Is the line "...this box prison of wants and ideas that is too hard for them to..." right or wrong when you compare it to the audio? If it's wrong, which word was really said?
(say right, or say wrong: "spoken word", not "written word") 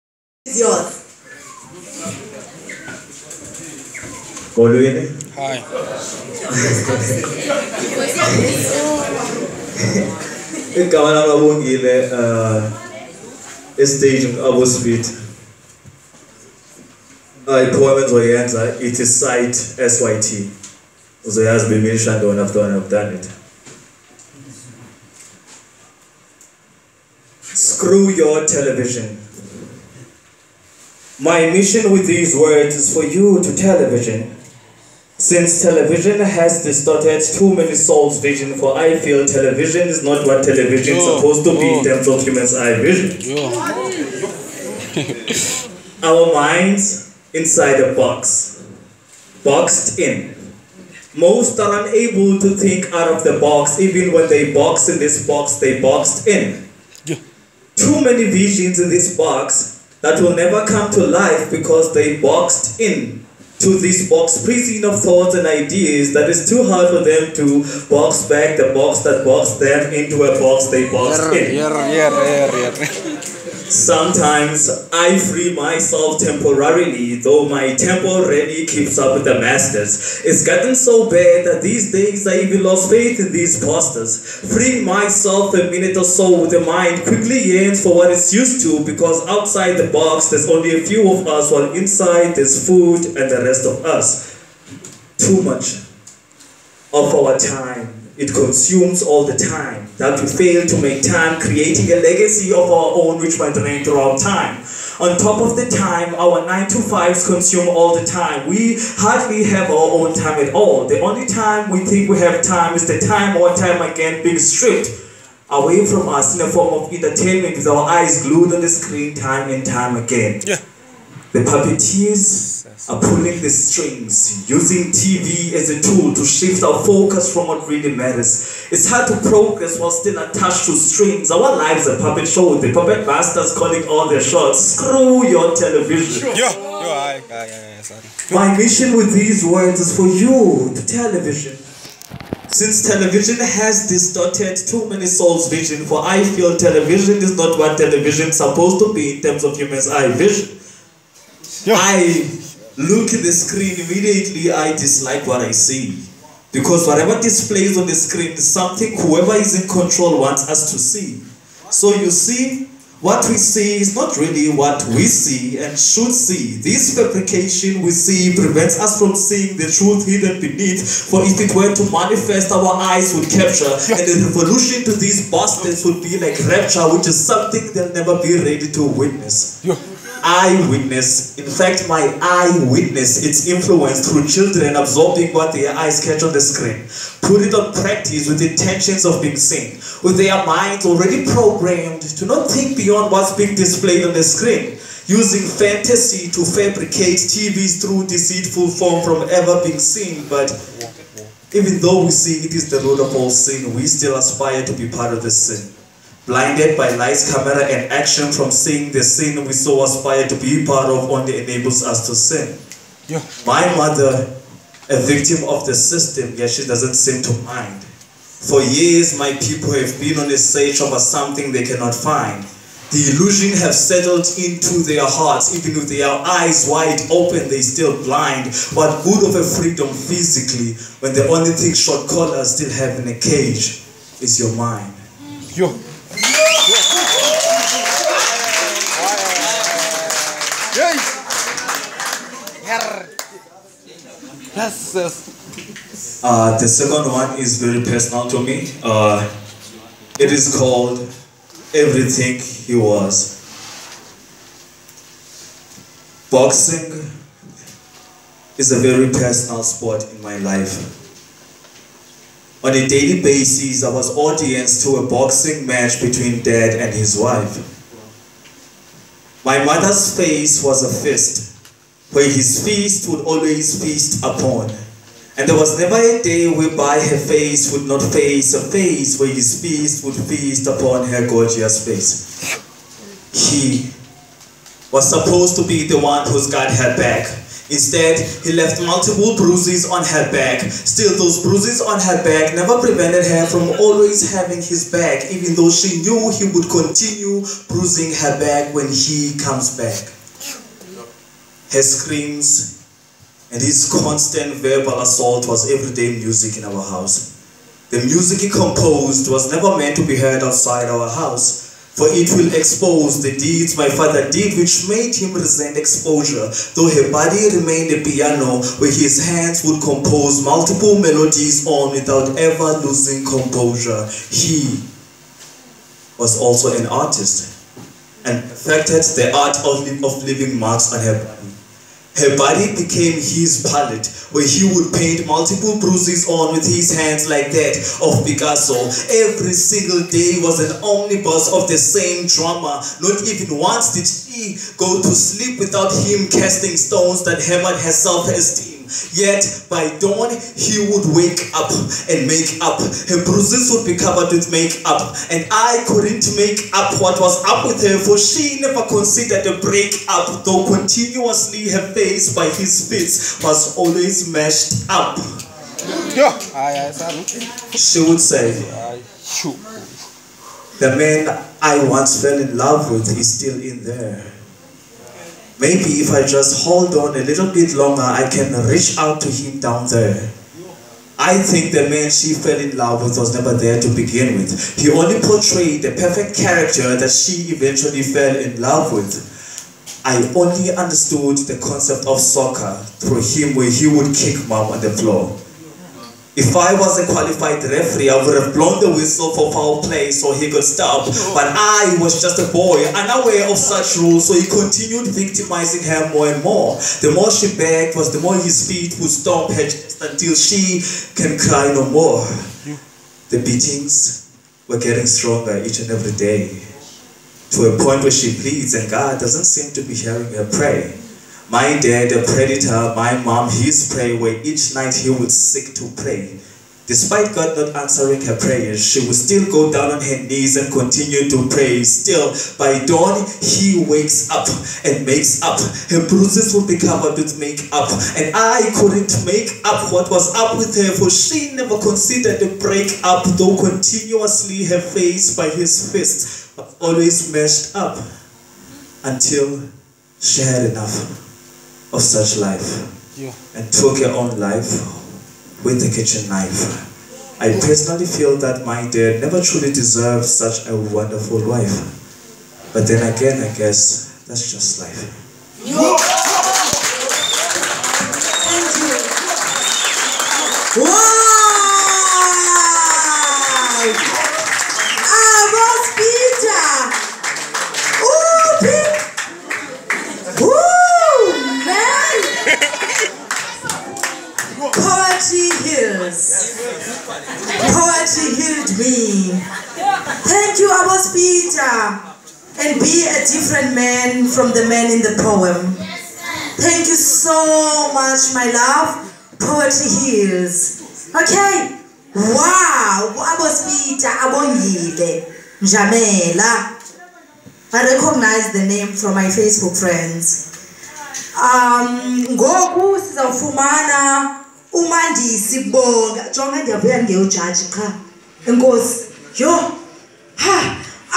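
wrong: "thoughts", not "wants".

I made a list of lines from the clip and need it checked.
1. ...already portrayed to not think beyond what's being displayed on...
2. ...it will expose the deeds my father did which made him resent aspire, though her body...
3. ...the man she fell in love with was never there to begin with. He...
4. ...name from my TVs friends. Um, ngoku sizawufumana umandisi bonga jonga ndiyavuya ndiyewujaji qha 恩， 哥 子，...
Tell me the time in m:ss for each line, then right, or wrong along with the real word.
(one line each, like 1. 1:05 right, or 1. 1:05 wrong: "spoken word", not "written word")
1. 3:10 wrong: "programmed", not "portrayed"
2. 5:12 wrong: "exposure", not "aspire"
3. 6:21 right
4. 8:28 wrong: "Facebook", not "TVs".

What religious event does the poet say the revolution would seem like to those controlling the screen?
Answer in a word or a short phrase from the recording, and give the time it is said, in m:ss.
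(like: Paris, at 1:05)
rapture, at 2:56.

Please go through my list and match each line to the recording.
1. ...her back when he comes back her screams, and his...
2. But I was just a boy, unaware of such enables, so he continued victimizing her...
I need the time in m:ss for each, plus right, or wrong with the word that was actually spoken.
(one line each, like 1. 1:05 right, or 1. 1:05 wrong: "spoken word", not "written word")
1. 4:58 right
2. 6:41 wrong: "rules", not "enables".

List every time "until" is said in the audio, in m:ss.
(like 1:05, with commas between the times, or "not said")
6:49, 7:29.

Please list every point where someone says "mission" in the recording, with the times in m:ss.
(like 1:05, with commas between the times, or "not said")
0:31, 2:18.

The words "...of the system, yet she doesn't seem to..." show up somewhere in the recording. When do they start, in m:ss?
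3:35.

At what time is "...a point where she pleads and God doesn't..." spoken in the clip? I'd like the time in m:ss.
6:57.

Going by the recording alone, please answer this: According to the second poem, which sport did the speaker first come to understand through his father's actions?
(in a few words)
soccer.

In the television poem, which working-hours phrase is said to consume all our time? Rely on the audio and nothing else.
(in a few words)
9 to 5s.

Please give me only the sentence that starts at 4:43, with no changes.
He was supposed to be the one who's got her back.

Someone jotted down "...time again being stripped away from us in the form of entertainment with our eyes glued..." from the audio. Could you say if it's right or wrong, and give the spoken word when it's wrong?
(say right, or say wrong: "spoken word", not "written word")
right.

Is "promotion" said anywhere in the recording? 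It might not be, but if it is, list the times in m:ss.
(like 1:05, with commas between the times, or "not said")
not said.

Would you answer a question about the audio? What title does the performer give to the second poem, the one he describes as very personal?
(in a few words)
Everything He Was.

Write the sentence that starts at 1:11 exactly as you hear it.
Yeah, yeah, yeah, Sometimes I free myself temporarily, though my tempo really keeps up with the masters.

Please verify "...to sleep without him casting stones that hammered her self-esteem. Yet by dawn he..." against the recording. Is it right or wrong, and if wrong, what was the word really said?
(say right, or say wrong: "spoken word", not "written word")
right.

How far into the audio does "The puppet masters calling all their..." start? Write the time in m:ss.
2:12.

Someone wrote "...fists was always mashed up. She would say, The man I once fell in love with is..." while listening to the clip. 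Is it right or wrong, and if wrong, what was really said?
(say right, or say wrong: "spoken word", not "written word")
right.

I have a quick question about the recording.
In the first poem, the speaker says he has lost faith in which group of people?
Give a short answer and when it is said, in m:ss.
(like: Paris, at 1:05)
pastors, at 1:23.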